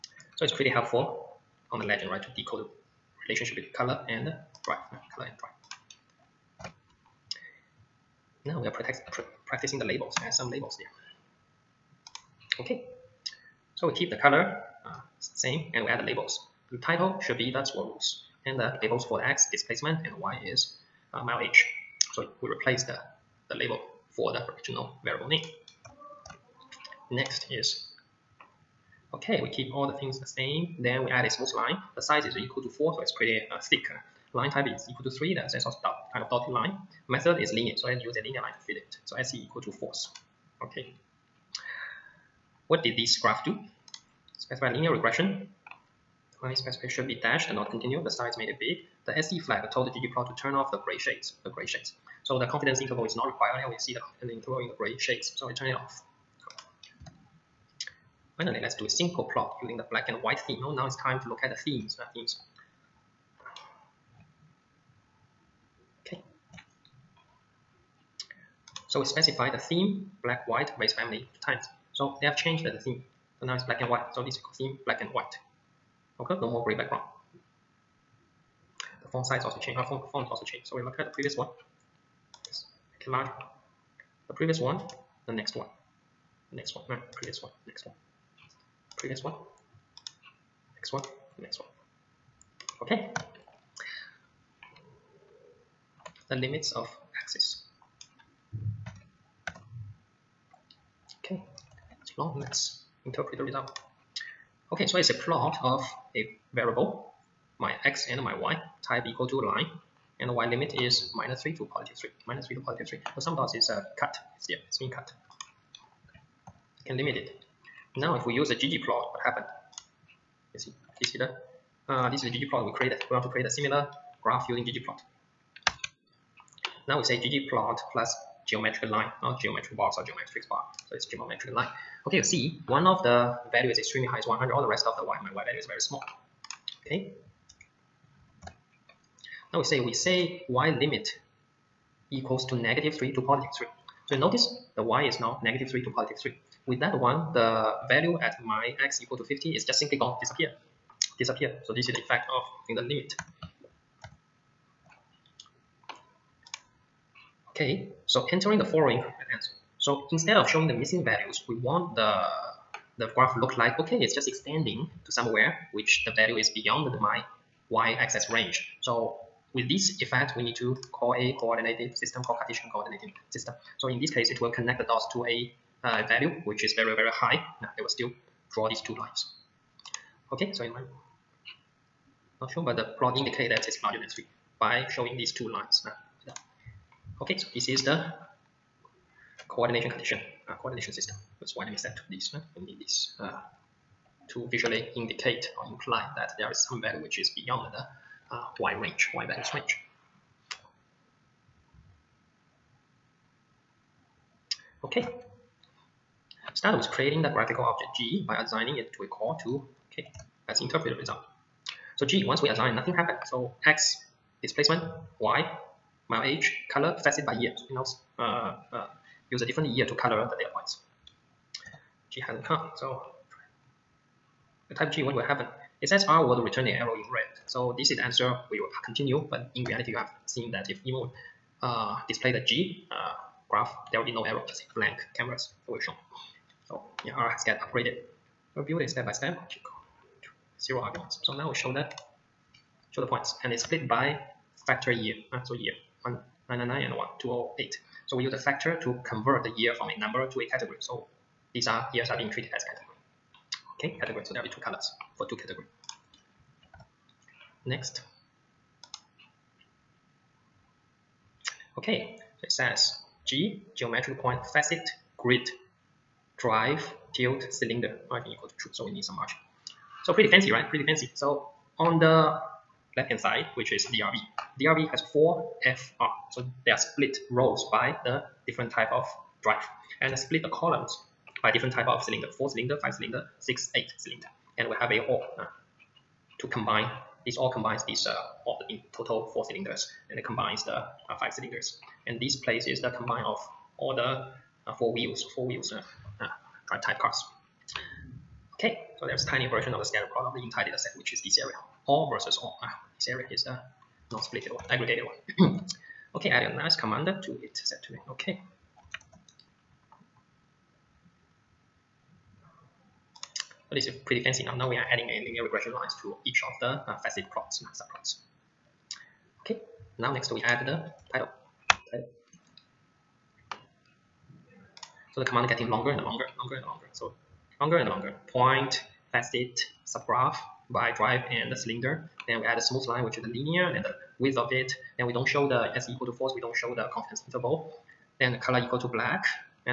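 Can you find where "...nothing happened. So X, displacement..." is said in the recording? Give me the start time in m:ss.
3:32.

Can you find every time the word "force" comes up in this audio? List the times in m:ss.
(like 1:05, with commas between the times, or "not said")
0:39, 5:36.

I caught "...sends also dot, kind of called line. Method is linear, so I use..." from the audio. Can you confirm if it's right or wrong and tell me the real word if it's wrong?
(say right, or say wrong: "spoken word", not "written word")
wrong: "dotted", not "called".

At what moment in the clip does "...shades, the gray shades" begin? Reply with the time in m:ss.
0:50.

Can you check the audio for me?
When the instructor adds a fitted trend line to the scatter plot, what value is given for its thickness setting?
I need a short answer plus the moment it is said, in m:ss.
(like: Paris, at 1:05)
4, at 0:31.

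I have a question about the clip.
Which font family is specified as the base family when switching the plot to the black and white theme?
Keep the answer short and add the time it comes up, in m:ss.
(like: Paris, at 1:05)
Times, at 1:10.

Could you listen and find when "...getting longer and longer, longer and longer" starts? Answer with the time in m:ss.
5:25.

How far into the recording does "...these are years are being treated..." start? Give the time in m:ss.
4:11.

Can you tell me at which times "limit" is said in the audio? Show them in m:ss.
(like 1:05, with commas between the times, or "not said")
1:36, 1:50, 1:56, 2:20, 2:32.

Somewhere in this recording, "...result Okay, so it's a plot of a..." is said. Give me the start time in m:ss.
1:43.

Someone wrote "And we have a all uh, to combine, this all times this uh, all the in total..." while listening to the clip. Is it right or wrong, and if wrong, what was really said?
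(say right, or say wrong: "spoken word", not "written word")
wrong: "combines", not "times".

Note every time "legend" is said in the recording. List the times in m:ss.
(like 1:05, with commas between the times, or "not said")
0:01.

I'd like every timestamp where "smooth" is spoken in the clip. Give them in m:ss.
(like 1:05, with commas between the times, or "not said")
0:31, 5:32.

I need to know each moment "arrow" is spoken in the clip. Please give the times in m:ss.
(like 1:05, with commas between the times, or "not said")
3:46, 3:54.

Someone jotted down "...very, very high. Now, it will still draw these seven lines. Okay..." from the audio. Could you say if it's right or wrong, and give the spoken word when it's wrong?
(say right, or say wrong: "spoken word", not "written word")
wrong: "two", not "seven".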